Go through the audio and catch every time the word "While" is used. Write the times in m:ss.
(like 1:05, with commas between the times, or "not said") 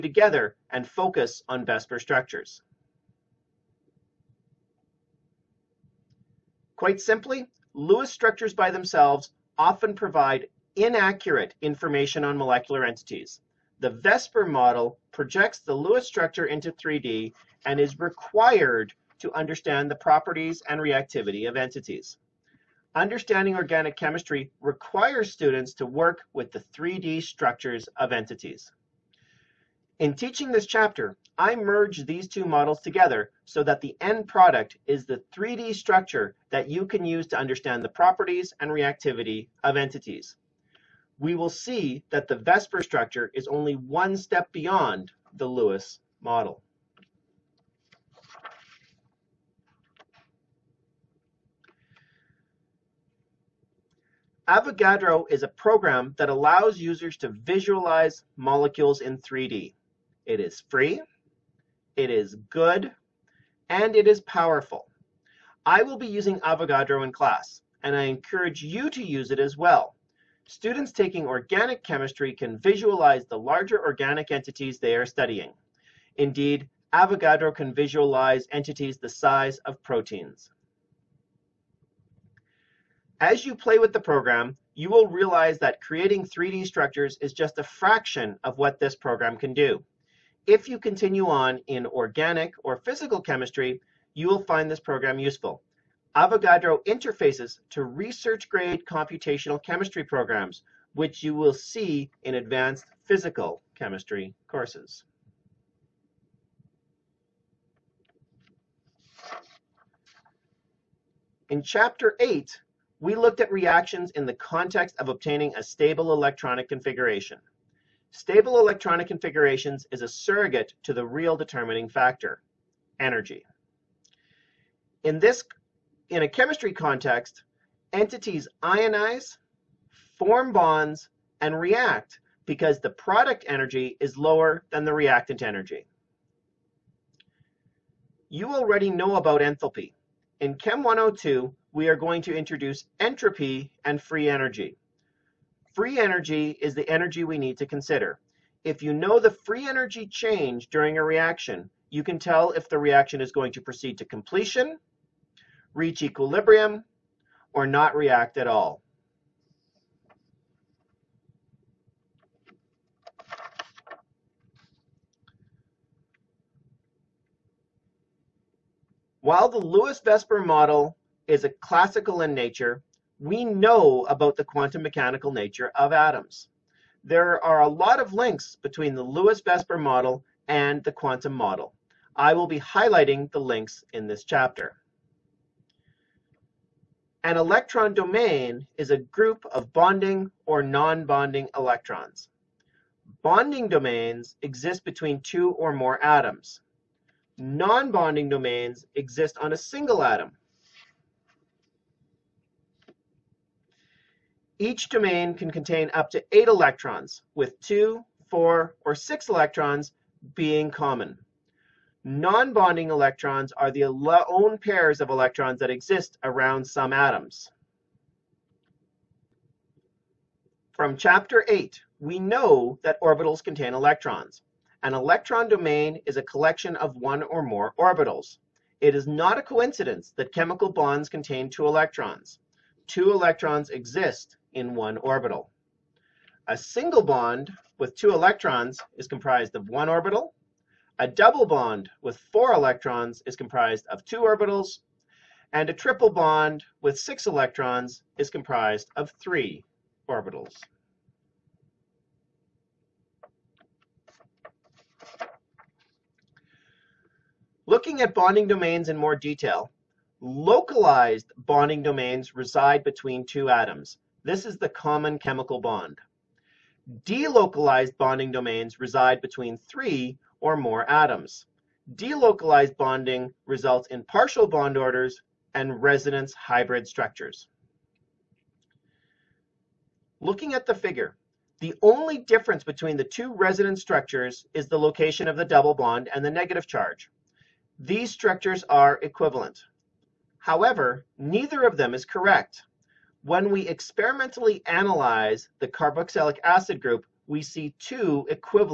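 2:49.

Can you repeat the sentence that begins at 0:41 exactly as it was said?
We will see that the VSEPR structure is only one step beyond the Lewis model.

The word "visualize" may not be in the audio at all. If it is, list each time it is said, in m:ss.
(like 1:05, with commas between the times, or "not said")
0:57, 1:12, 1:17.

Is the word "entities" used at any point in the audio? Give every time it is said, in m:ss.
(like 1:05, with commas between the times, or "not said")
0:12, 0:21, 0:28, 0:39, 1:14, 1:18, 2:07.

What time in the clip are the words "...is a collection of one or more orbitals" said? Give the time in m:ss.
3:46.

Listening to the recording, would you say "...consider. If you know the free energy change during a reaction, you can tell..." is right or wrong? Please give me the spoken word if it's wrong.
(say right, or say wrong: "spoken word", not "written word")
right.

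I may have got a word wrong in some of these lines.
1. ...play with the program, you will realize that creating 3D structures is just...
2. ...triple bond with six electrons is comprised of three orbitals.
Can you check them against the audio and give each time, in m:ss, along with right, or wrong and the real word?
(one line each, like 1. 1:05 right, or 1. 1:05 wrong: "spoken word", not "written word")
1. 1:23 right
2. 4:05 right.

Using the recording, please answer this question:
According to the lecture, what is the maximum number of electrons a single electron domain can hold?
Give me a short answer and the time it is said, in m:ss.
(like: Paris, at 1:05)
8, at 3:26.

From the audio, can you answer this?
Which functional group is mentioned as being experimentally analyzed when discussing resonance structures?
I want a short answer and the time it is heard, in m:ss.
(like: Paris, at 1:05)
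carboxylic acid group, at 4:55.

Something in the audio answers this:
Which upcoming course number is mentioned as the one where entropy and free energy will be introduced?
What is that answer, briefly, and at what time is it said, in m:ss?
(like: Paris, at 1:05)
Chem 102, at 2:20.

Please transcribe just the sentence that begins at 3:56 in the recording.
A single bond with two electrons is comprised of one orbital.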